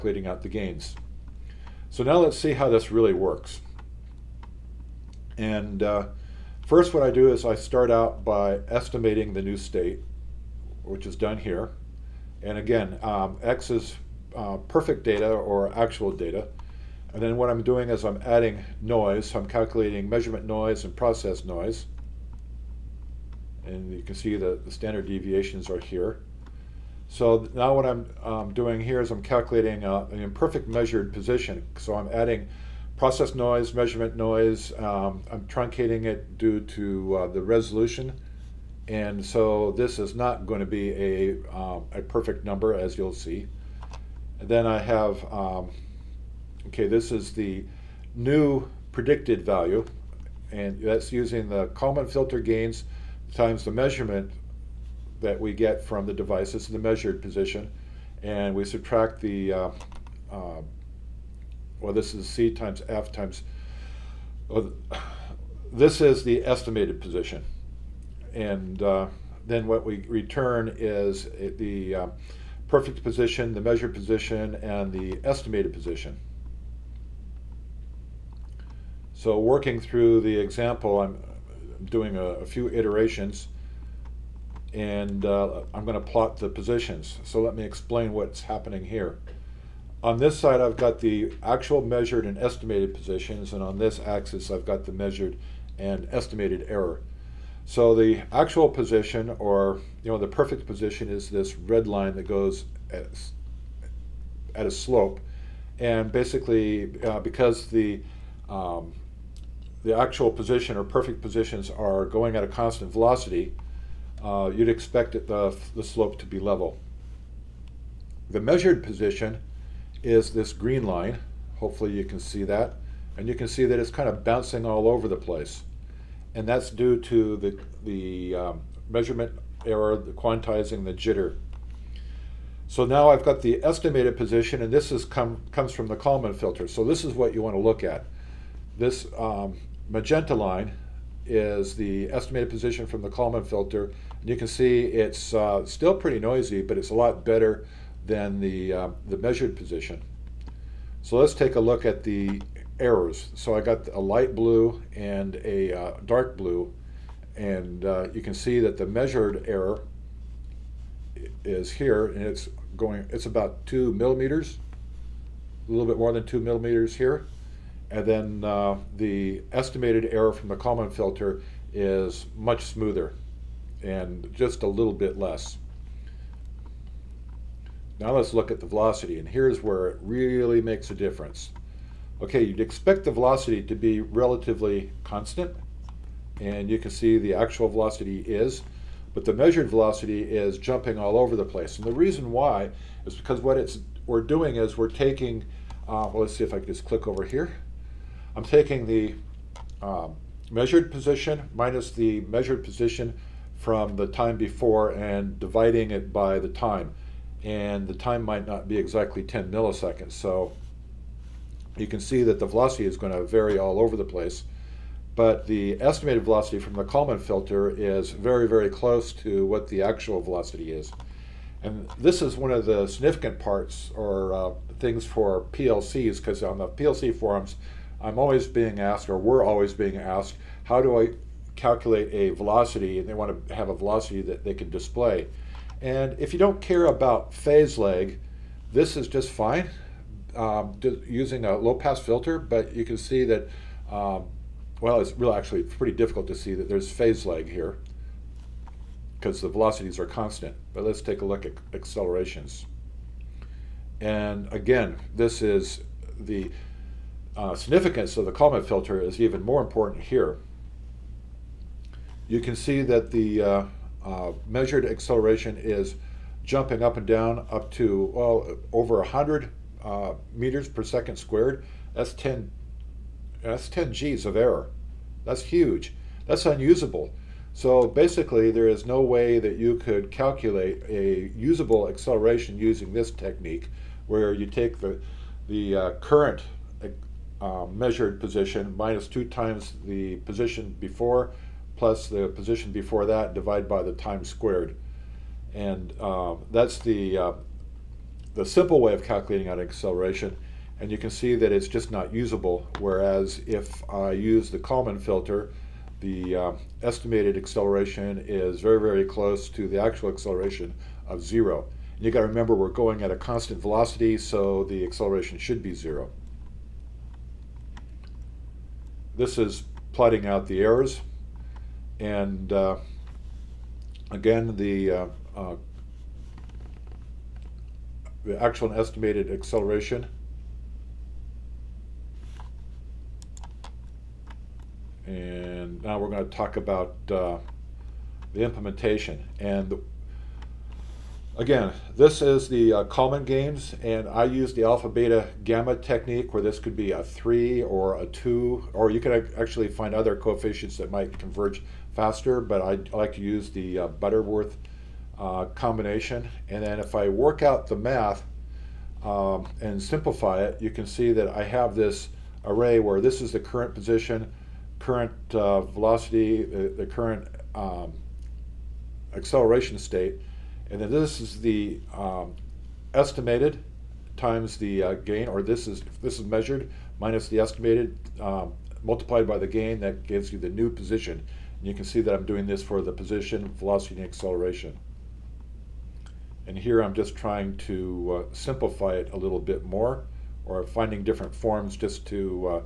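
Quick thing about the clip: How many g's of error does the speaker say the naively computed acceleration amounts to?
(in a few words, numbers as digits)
10 g's.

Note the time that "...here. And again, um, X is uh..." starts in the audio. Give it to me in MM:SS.
00:11.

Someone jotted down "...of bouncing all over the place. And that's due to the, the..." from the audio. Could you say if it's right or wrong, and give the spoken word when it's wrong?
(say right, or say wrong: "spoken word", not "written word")
right.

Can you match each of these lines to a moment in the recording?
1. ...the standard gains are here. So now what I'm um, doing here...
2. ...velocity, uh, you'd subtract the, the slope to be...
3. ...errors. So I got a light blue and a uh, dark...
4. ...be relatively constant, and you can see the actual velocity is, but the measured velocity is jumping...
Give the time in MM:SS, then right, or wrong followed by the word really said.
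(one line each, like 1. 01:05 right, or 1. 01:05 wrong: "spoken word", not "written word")
1. 00:24 wrong: "deviations", not "gains"
2. 01:52 wrong: "expect", not "subtract"
3. 02:32 right
4. 03:03 right.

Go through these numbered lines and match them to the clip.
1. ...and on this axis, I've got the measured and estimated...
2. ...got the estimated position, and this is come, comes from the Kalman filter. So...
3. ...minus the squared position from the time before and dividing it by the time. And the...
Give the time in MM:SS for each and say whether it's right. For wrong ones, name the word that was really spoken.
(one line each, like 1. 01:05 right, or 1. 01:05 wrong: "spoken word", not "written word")
1. 01:33 right
2. 02:13 right
3. 03:21 wrong: "measured", not "squared".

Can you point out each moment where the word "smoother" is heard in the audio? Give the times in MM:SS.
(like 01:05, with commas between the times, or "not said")
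02:52.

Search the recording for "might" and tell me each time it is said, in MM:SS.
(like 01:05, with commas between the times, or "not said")
03:28, 05:50.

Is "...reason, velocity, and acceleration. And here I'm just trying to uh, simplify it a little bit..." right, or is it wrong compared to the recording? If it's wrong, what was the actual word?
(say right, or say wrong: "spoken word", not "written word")
wrong: "position", not "reason".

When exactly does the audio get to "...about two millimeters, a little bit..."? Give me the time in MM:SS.
02:43.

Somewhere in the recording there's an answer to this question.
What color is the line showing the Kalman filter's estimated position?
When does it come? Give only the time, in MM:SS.
02:19.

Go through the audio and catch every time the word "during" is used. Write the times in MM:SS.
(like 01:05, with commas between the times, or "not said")
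not said.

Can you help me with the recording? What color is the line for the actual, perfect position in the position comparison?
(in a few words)
Red.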